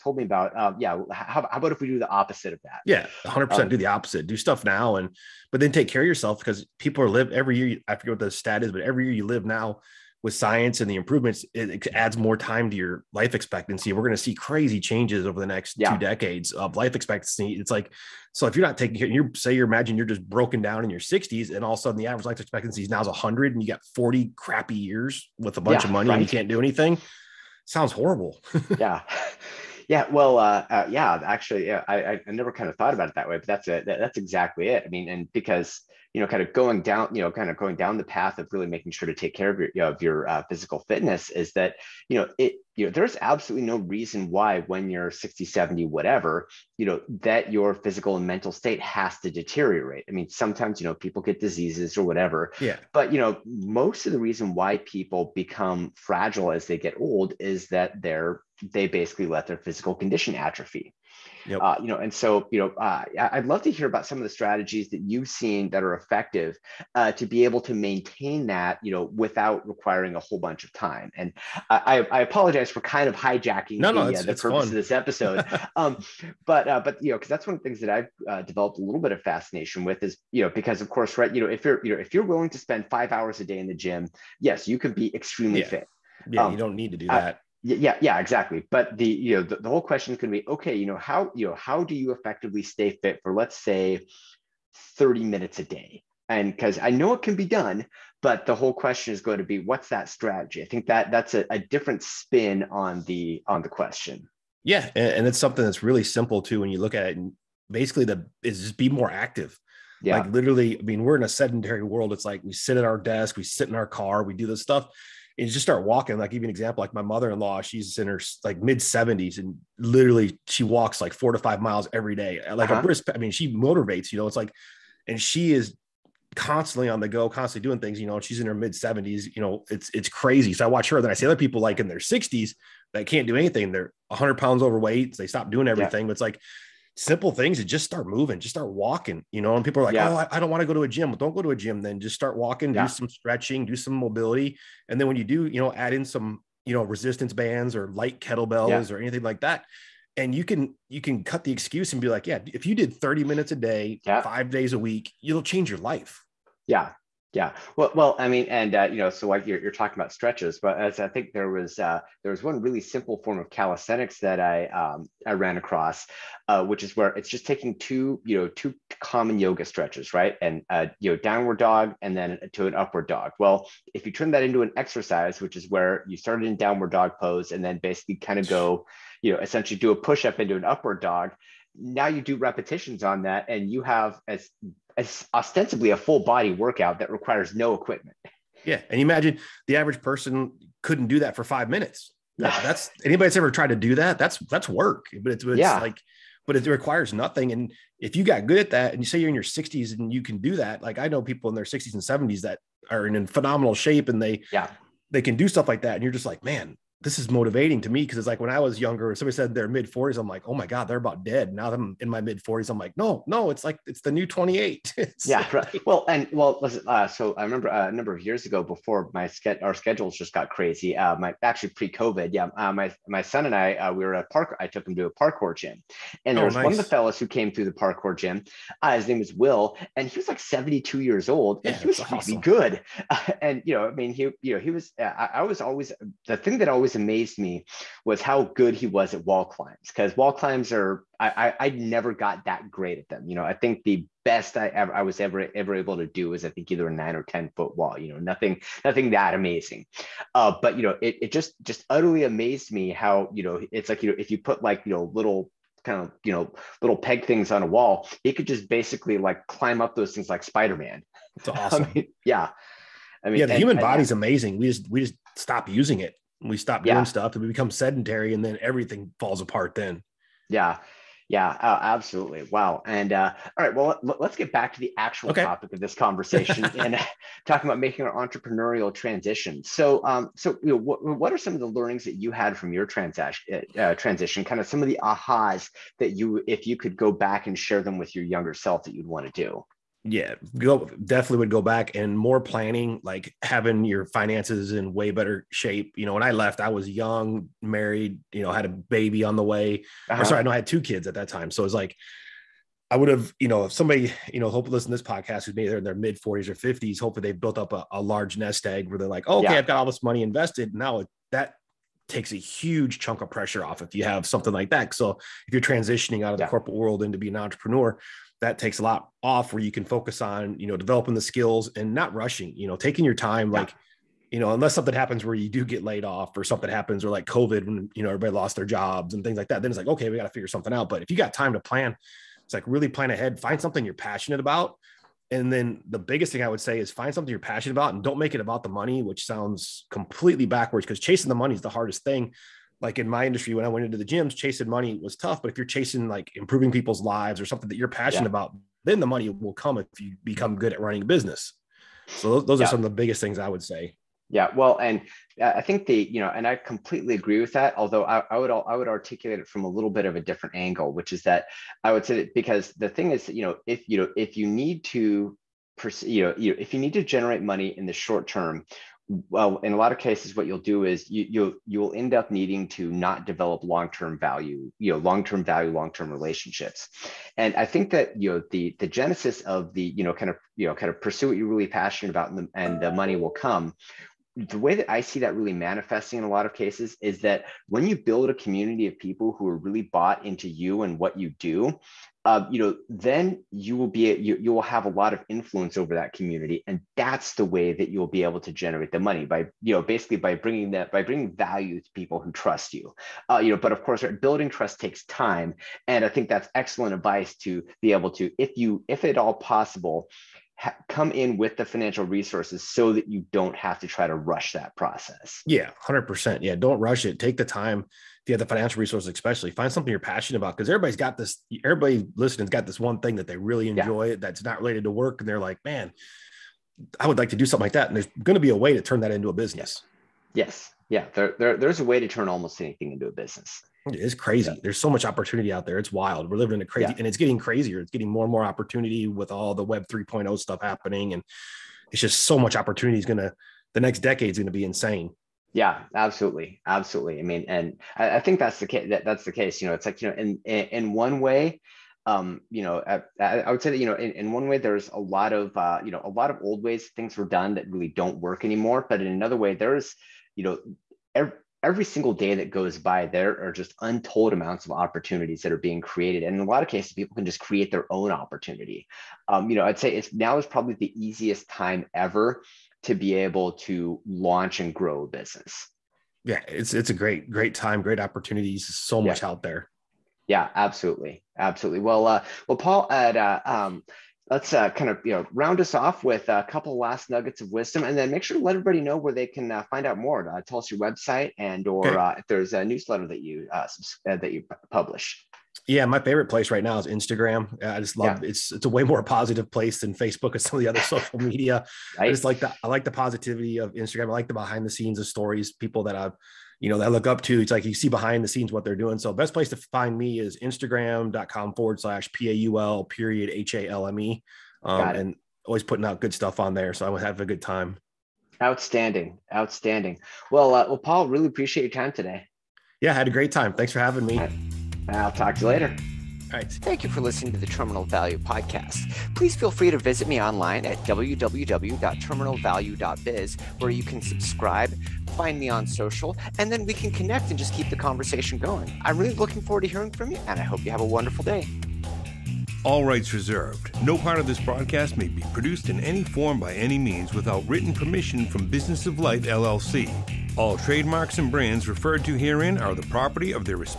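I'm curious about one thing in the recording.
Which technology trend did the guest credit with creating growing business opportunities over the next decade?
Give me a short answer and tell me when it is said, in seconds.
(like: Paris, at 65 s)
Web 3.0, at 439 s.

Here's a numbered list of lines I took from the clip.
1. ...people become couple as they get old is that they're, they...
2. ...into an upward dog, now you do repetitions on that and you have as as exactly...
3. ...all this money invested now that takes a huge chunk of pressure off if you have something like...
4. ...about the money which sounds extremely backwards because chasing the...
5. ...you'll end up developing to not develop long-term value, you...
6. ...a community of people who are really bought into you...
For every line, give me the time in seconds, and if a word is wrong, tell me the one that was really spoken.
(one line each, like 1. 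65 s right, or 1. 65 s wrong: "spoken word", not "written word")
1. 54 s wrong: "fragile", not "couple"
2. 180 s wrong: "ostensibly", not "exactly"
3. 309 s right
4. 338 s wrong: "completely", not "extremely"
5. 371 s wrong: "needing", not "developing"
6. 388 s right.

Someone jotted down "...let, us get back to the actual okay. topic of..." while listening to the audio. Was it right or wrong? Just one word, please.
right.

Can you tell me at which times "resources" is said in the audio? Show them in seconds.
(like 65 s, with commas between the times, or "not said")
412 s, 418 s.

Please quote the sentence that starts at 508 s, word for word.
So best place to find me is Instagram.com forward slash P A U L period H A L M E.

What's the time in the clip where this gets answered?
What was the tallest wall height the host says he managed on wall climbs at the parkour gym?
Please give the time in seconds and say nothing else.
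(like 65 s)
246 s.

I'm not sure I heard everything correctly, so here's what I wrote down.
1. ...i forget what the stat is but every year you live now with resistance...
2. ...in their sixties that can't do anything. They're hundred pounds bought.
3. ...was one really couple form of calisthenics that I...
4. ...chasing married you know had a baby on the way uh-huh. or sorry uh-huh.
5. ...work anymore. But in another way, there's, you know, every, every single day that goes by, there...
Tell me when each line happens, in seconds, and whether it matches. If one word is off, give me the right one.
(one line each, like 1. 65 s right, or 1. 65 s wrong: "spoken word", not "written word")
1. 7 s wrong: "science", not "resistance"
2. 131 s wrong: "overweight", not "bought"
3. 162 s wrong: "simple", not "couple"
4. 296 s wrong: "young", not "chasing"
5. 458 s right.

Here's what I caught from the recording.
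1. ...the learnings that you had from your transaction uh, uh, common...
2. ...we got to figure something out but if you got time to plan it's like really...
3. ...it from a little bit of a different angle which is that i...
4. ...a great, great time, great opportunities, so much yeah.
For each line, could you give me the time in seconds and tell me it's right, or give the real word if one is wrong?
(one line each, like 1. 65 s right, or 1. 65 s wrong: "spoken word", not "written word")
1. 281 s wrong: "transition", not "common"
2. 330 s right
3. 359 s right
4. 476 s right.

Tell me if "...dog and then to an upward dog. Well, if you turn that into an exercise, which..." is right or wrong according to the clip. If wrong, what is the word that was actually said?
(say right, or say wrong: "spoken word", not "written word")
right.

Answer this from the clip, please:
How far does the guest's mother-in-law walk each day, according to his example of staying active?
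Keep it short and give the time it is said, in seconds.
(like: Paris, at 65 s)
4 to 5 miles, at 121 s.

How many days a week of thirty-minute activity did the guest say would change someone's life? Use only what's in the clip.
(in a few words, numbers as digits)
5.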